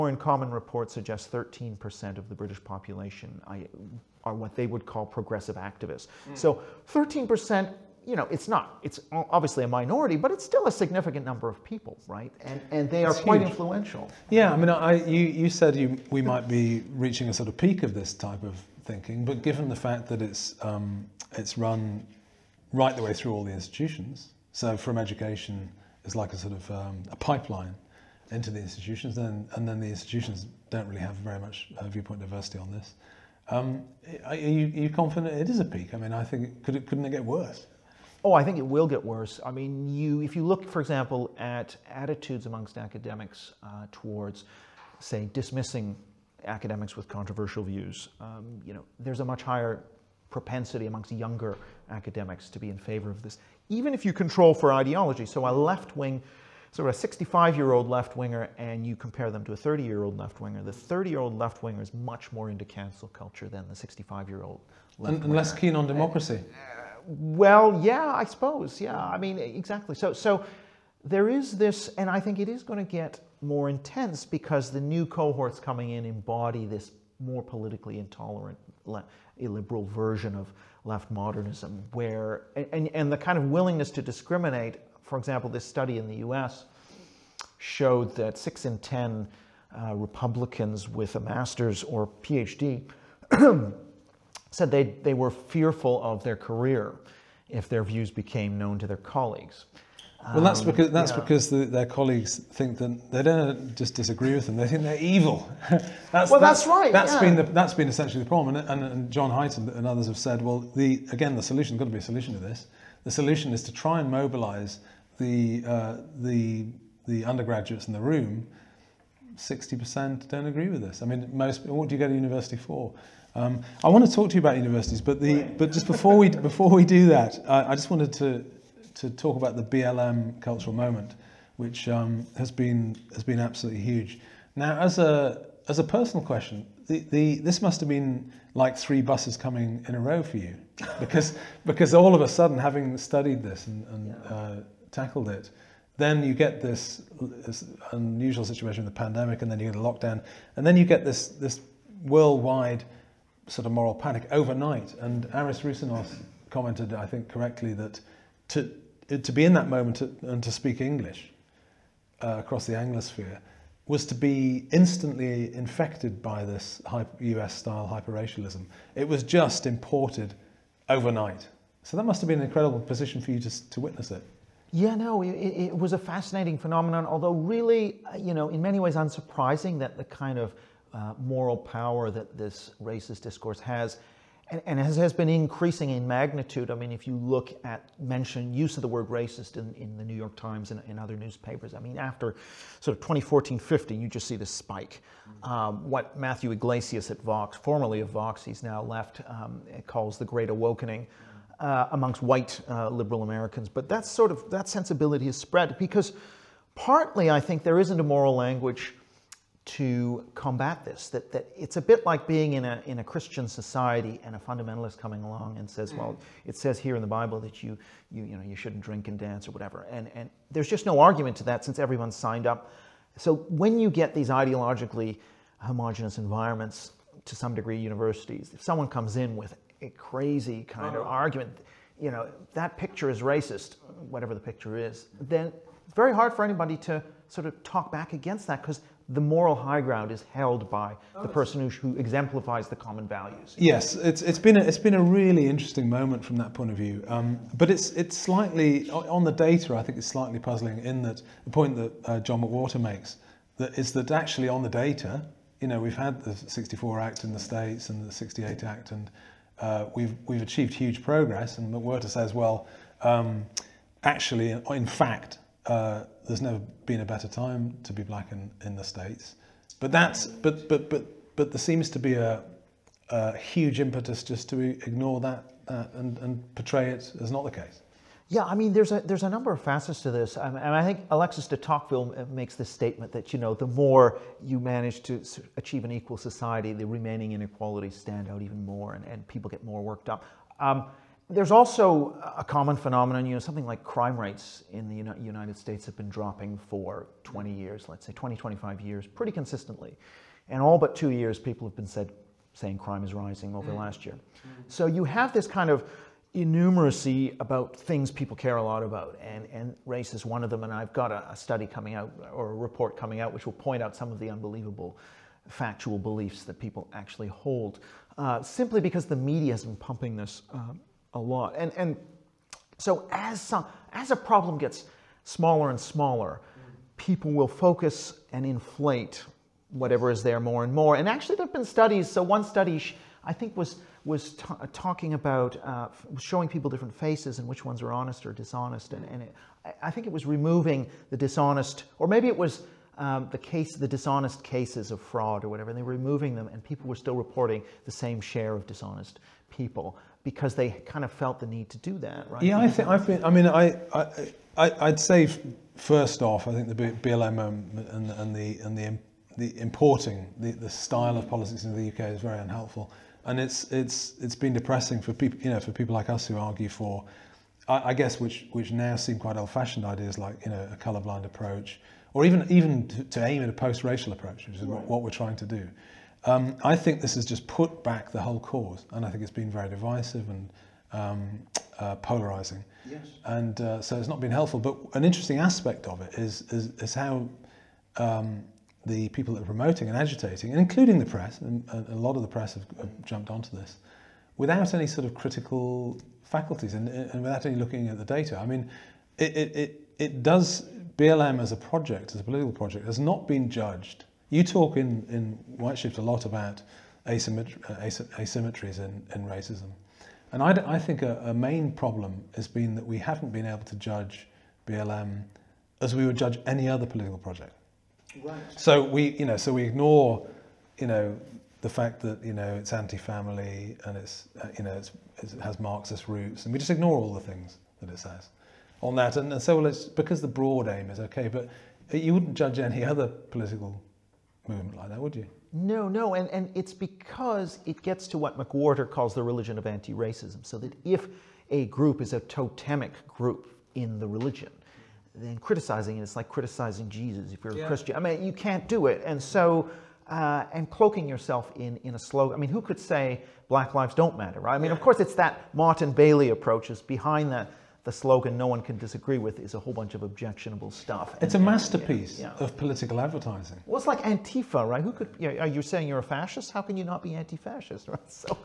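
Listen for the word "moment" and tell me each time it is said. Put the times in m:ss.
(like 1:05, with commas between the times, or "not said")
2:10, 2:39, 4:05.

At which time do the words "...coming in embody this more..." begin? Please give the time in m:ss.
1:15.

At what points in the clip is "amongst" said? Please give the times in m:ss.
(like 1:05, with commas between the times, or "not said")
0:42, 0:50, 3:21.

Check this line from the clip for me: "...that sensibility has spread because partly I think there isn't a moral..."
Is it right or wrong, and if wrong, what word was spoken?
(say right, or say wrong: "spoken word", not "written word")
right.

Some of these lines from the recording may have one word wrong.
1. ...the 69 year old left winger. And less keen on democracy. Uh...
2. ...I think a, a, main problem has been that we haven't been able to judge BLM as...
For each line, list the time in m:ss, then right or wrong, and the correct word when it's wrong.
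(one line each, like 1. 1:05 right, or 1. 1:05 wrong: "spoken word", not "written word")
1. 1:03 wrong: "65", not "69"
2. 6:50 right.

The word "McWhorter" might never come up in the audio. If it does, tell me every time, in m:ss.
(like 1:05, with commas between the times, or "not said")
4:12, 4:21, 7:18.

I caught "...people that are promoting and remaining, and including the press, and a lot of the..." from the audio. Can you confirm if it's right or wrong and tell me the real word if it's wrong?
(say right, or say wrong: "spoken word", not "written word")
wrong: "agitating", not "remaining".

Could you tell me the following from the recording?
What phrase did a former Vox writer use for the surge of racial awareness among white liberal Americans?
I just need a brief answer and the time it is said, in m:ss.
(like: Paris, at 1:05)
the Great Awakening, at 3:20.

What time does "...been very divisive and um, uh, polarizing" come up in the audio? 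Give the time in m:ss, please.
6:19.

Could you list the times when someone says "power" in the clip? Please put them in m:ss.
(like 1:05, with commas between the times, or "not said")
3:01.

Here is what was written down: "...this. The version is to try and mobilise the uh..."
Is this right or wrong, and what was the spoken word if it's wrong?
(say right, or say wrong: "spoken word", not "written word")
wrong: "solution", not "version".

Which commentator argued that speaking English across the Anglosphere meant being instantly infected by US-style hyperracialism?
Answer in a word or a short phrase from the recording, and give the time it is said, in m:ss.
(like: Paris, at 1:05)
Aris Roussinos, at 2:35.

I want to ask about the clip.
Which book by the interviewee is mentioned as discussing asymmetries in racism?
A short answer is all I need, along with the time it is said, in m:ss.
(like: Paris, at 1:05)
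Whiteshift, at 6:45.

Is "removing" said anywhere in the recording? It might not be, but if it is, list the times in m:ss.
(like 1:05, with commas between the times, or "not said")
5:40, 5:45.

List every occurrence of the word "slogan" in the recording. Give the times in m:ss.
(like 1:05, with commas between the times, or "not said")
7:31, 7:37.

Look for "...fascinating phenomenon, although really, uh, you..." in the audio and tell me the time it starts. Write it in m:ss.
2:55.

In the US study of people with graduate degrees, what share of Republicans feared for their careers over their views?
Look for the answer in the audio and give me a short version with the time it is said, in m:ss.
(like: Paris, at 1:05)
six in ten, at 1:28.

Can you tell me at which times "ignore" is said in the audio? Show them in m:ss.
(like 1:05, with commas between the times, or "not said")
4:34, 6:59, 7:06.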